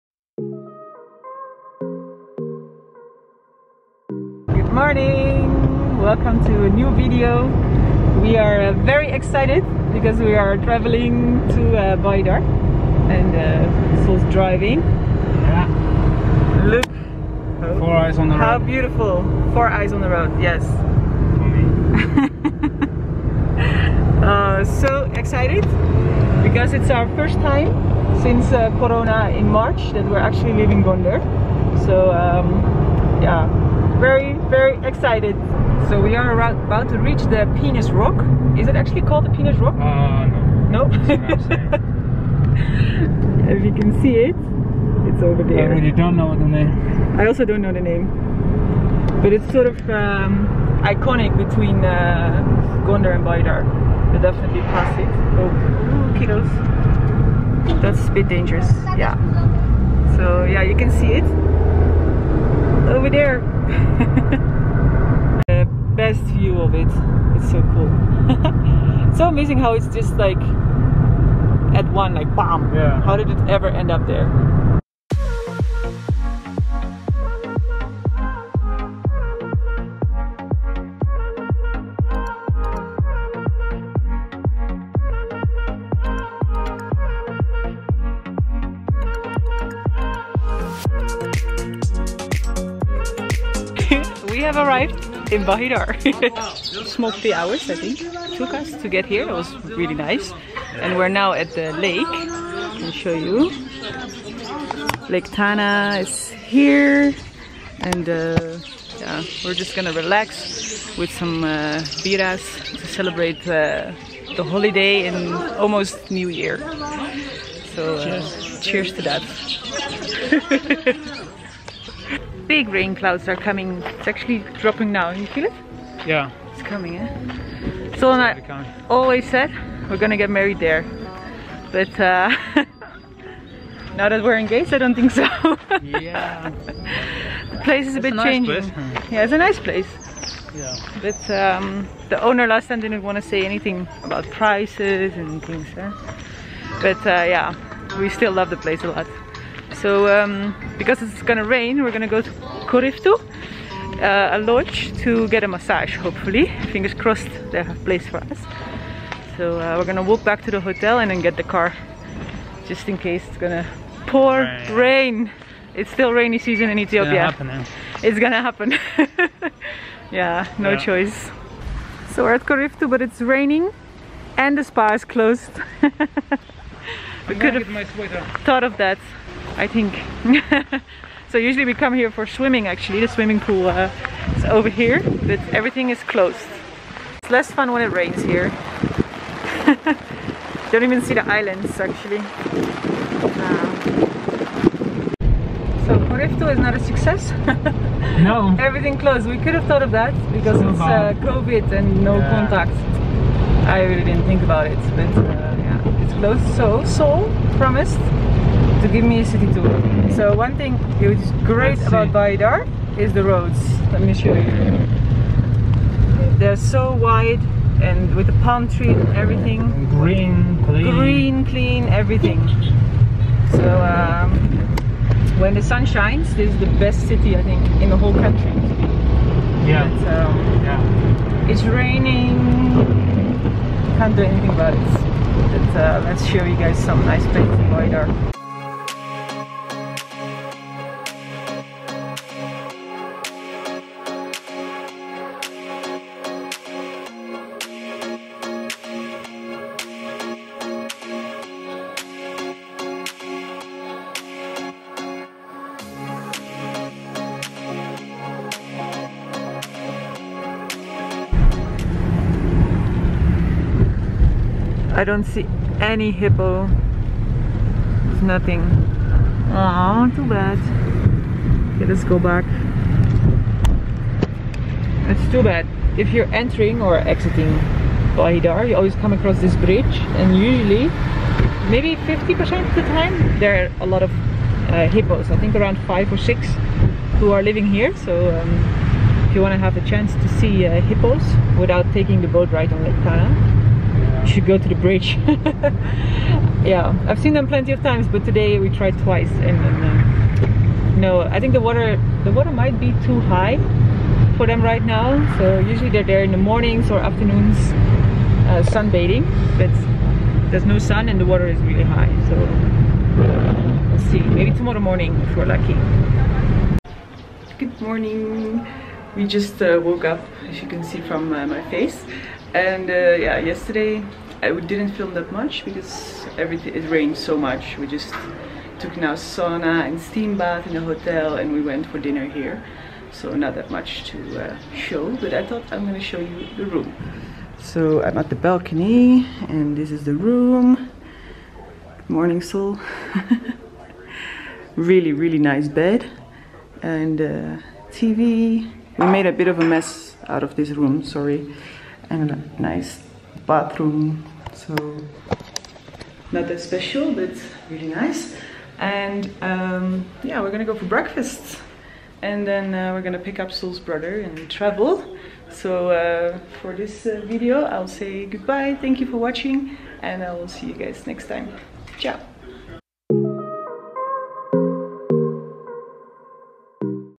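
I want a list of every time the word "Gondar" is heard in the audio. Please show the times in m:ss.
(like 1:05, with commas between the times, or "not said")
0:30, 0:52.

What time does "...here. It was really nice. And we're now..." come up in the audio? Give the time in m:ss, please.
1:39.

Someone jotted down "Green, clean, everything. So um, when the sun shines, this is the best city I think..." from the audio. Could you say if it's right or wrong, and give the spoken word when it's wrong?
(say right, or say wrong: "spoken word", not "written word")
right.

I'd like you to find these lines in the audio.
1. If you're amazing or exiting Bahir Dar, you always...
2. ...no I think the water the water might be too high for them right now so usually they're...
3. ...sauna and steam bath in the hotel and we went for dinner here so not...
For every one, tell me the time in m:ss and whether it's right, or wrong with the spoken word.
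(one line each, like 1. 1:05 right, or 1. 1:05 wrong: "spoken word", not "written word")
1. 4:35 wrong: "entering", not "amazing"
2. 5:00 right
3. 5:29 right.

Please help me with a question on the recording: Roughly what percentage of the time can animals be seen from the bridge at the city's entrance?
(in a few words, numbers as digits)
50%.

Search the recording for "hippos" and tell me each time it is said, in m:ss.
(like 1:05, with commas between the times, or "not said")
4:26, 4:44, 4:50.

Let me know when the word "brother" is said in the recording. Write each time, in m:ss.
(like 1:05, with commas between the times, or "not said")
6:03.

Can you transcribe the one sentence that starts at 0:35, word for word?
So we are about to reach the Penis Rock.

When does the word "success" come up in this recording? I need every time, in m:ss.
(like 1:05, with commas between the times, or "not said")
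3:16.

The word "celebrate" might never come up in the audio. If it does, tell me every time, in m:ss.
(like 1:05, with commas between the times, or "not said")
1:52.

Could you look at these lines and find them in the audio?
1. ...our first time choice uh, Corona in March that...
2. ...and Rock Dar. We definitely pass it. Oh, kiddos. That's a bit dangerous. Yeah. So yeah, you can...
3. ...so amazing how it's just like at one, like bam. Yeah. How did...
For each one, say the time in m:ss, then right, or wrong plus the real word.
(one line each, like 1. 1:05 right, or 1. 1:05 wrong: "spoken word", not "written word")
1. 0:26 wrong: "since", not "choice"
2. 0:53 wrong: "Bahir", not "Rock"
3. 1:09 right.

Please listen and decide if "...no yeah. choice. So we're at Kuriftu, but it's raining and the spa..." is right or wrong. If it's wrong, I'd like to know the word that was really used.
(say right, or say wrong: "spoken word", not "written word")
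right.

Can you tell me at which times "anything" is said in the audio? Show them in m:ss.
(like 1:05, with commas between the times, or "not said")
2:23, 3:54.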